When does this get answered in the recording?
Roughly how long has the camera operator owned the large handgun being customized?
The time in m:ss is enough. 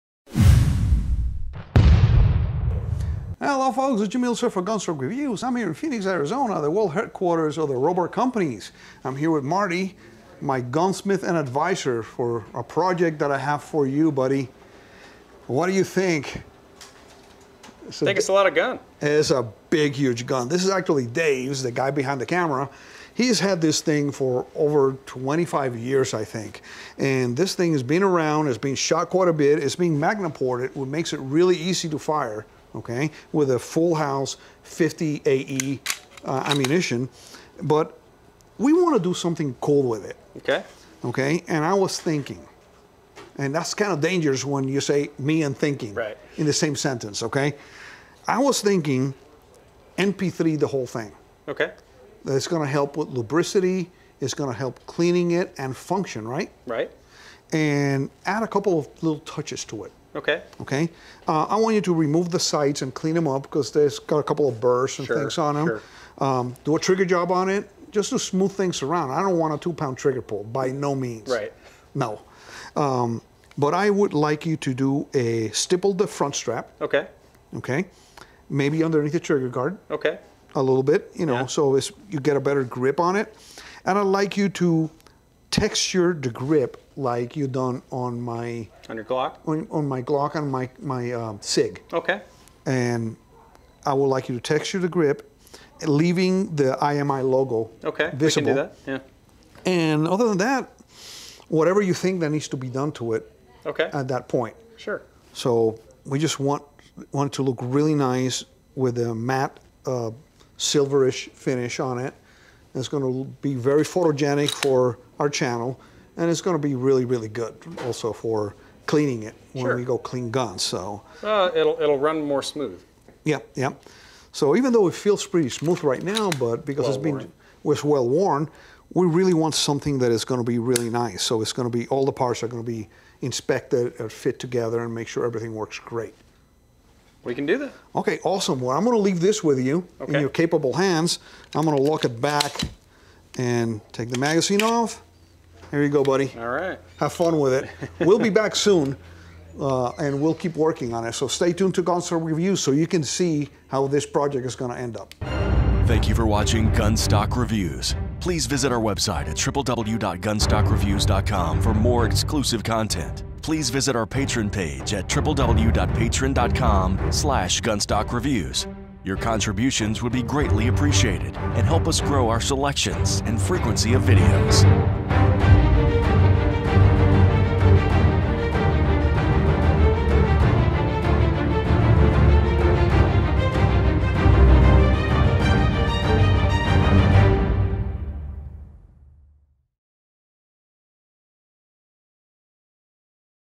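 0:24.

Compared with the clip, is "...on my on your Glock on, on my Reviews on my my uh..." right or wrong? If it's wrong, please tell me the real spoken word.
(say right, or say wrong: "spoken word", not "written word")
wrong: "Glock", not "Reviews".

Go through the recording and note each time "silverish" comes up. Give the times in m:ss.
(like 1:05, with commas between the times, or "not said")
1:50.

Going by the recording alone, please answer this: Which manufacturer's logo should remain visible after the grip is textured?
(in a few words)
IMI.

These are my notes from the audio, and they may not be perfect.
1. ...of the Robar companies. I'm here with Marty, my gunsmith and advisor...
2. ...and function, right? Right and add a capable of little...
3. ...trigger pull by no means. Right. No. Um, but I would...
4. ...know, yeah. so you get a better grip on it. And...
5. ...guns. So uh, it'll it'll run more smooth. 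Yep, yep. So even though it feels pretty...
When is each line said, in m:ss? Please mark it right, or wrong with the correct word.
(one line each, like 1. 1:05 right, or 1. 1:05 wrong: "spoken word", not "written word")
1. 0:07 right
2. 0:55 wrong: "couple", not "capable"
3. 1:09 right
4. 1:21 right
5. 2:00 right.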